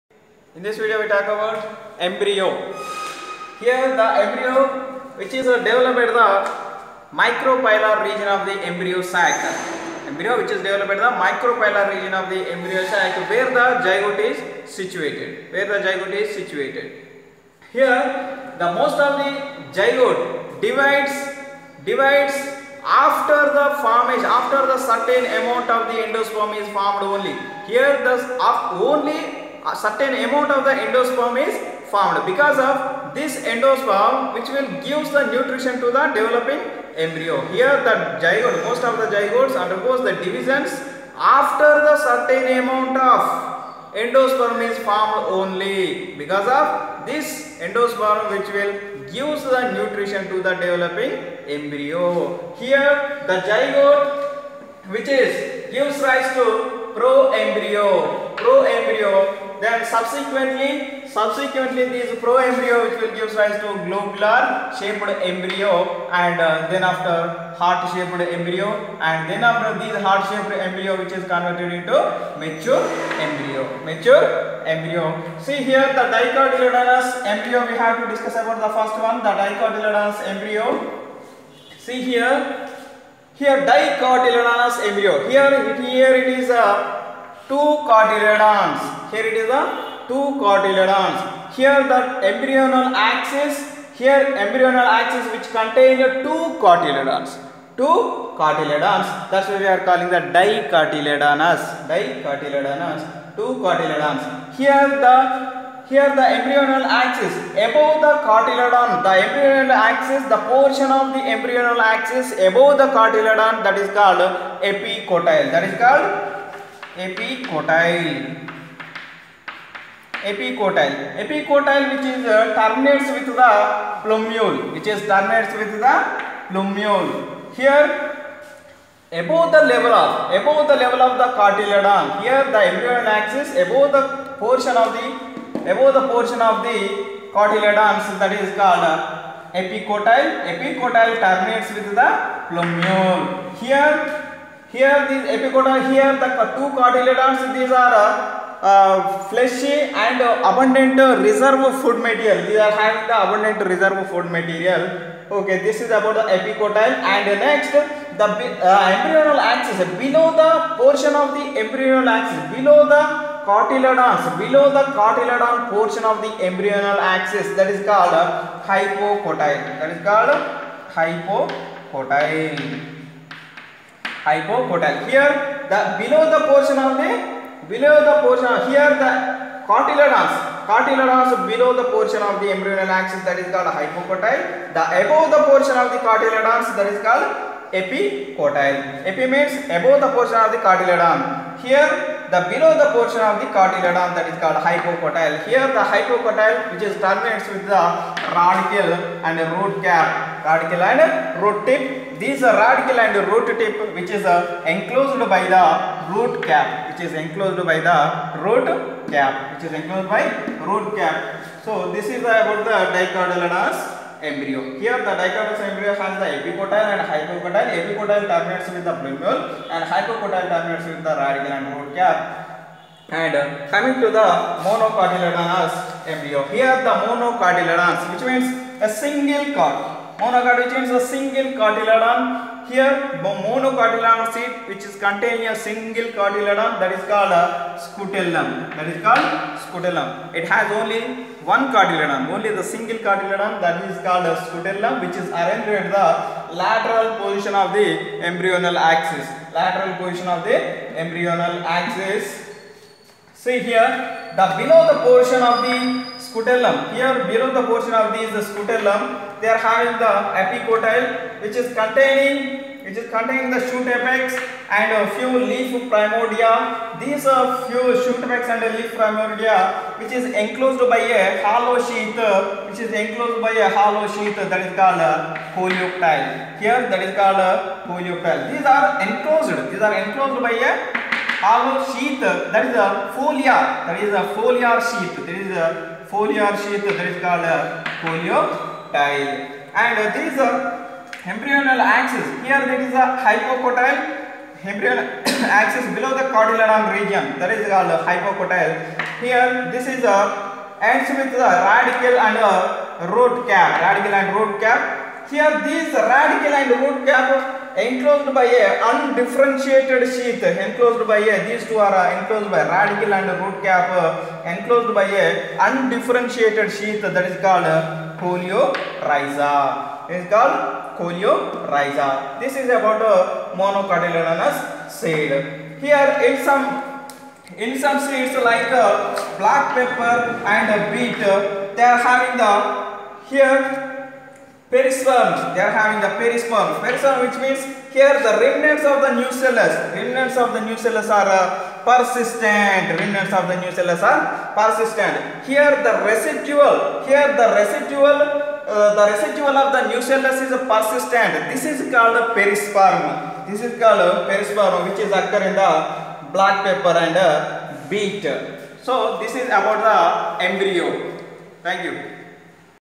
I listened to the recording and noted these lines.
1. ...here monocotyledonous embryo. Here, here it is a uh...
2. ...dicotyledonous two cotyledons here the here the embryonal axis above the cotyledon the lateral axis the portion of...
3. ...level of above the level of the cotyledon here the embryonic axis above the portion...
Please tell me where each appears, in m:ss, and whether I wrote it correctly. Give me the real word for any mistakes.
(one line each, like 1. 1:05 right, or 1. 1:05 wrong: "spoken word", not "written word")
1. 1:23 wrong: "dicotyledonous", not "monocotyledonous"
2. 1:41 wrong: "embryonal", not "lateral"
3. 2:09 right.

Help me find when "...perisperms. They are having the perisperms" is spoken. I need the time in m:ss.
5:34.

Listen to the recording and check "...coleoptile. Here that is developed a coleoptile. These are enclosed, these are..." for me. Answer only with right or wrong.
wrong.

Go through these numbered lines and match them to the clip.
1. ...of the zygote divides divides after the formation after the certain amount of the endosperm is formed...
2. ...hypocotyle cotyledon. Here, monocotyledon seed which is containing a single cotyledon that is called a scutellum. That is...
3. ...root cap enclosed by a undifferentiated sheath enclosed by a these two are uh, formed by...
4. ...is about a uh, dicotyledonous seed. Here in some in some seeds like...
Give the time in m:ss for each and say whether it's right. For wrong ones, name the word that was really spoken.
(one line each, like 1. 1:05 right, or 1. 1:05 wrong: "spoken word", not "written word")
1. 0:18 right
2. 3:51 wrong: "single", not "hypocotyle"
3. 5:06 wrong: "enclosed", not "formed"
4. 5:22 wrong: "monocotyledonous", not "dicotyledonous".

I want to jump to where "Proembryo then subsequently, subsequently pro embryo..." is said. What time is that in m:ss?
0:58.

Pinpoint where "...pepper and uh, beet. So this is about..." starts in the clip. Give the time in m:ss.
5:56.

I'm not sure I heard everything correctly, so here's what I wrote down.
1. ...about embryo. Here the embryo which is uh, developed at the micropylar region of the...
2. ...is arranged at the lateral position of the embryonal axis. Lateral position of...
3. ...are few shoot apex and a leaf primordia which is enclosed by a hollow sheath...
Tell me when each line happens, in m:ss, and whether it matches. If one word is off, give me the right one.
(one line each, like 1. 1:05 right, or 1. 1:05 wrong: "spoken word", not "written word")
1. 0:01 right
2. 4:05 right
3. 4:27 right.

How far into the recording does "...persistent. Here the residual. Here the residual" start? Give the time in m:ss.
5:44.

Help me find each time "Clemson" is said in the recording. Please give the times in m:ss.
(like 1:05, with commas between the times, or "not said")
not said.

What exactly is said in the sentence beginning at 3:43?
And uh, coming to the monocotyledonous embryo.